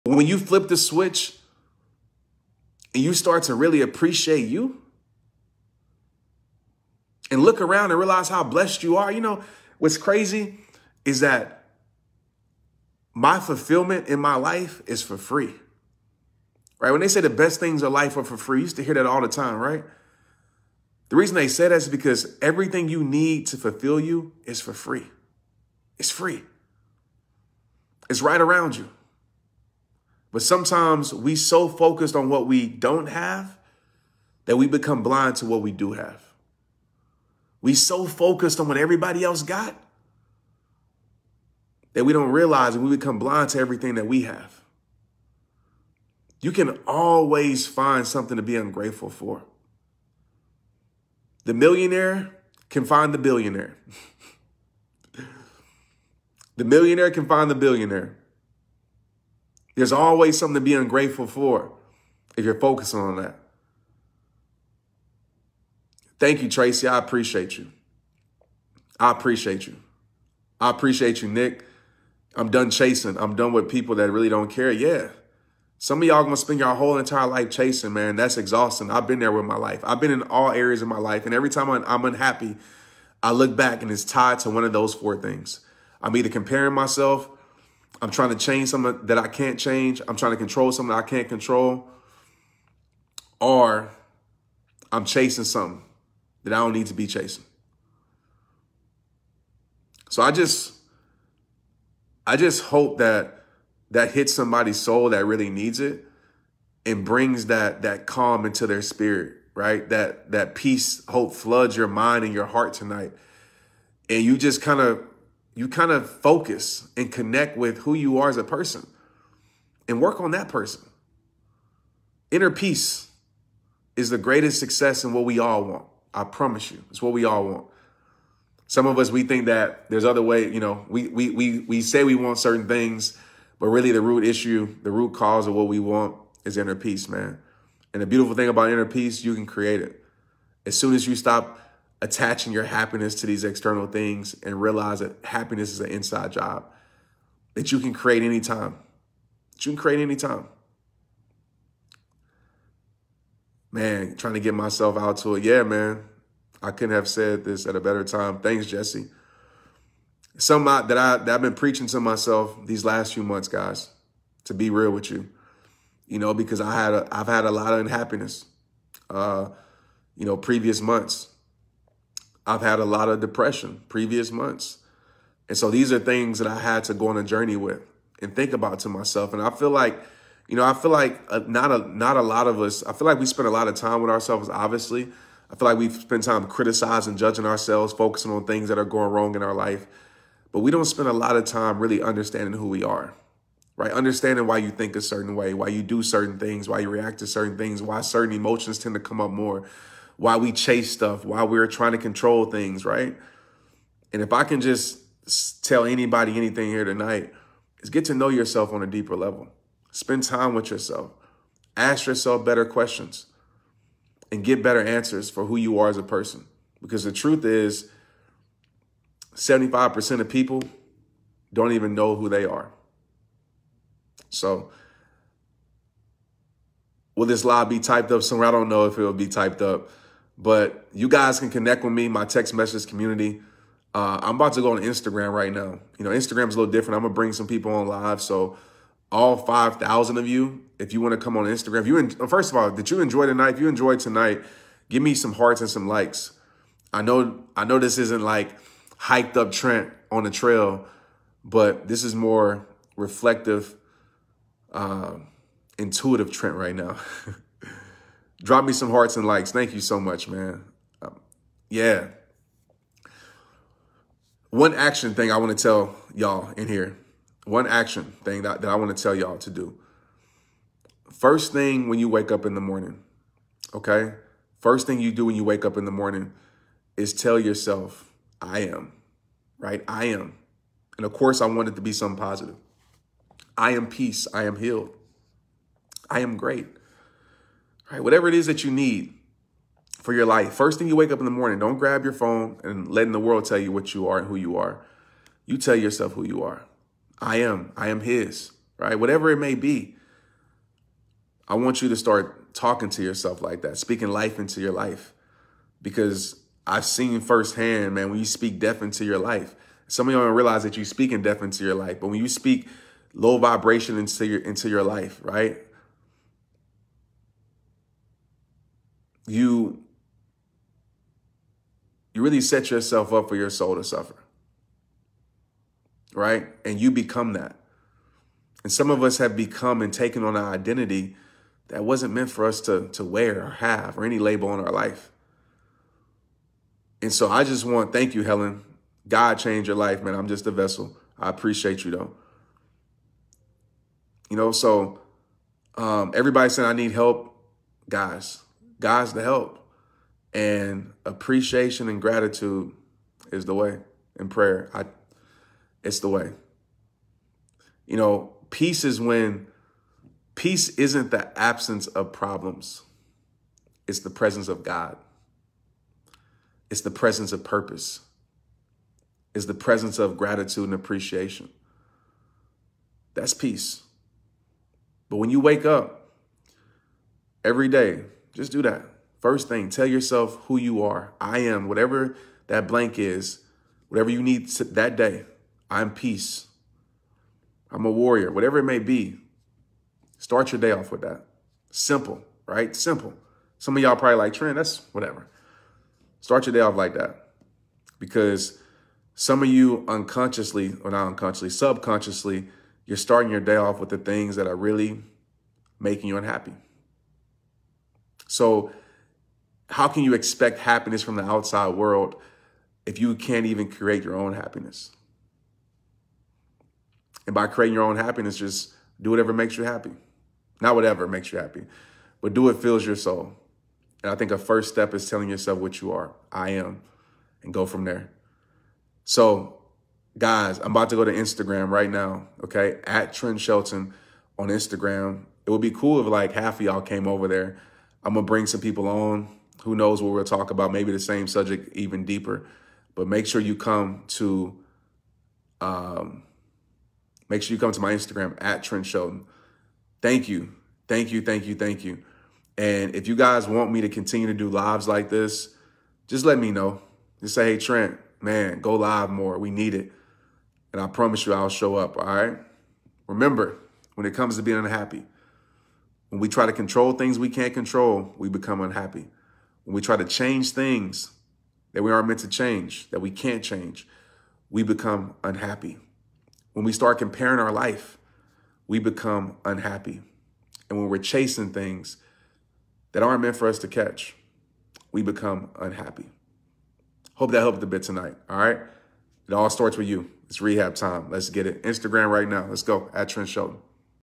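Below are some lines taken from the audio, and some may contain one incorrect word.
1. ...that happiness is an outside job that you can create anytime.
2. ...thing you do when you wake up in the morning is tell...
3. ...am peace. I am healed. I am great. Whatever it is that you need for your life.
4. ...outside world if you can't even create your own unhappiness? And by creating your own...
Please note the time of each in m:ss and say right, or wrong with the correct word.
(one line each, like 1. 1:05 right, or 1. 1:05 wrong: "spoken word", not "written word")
1. 2:24 wrong: "inside", not "outside"
2. 4:34 right
3. 4:43 right
4. 6:51 wrong: "happiness", not "unhappiness".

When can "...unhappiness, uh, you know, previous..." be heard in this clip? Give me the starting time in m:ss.
2:47.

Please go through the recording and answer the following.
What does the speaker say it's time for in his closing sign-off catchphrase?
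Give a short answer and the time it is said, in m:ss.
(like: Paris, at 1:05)
Rehab time, at 8:10.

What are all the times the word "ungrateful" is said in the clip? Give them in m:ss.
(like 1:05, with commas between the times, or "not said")
0:48, 1:00.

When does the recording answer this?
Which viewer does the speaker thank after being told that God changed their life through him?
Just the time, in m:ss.
5:38.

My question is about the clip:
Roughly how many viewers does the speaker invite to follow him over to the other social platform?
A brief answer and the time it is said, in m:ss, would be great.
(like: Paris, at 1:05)
5,000, at 3:59.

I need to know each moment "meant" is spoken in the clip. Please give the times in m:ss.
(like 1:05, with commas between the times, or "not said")
5:32, 7:52, 8:03.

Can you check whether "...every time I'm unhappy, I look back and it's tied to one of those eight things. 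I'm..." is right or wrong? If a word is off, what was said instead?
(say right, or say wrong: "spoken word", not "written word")
wrong: "four", not "eight".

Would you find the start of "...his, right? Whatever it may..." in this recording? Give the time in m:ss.
4:57.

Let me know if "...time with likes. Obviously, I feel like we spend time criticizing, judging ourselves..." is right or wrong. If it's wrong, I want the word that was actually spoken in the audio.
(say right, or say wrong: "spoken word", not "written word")
wrong: "ourselves", not "likes".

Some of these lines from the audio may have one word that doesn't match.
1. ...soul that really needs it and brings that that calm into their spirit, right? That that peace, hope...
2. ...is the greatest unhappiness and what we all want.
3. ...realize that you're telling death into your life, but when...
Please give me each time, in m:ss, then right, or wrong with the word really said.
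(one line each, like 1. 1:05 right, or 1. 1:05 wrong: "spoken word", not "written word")
1. 1:44 right
2. 2:03 wrong: "success", not "unhappiness"
3. 5:10 wrong: "speaking", not "telling".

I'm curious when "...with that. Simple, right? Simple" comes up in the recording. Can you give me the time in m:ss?
6:30.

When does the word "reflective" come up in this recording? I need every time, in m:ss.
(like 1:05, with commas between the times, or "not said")
4:12.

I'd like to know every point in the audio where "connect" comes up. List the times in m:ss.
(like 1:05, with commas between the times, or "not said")
1:57, 3:51.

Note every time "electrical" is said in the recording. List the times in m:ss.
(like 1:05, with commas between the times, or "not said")
not said.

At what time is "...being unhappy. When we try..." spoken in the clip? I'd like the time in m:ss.
7:44.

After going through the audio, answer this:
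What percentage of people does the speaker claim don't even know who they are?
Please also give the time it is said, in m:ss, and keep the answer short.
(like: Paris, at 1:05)
75%, at 3:39.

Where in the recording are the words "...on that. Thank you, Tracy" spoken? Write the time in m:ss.
1:02.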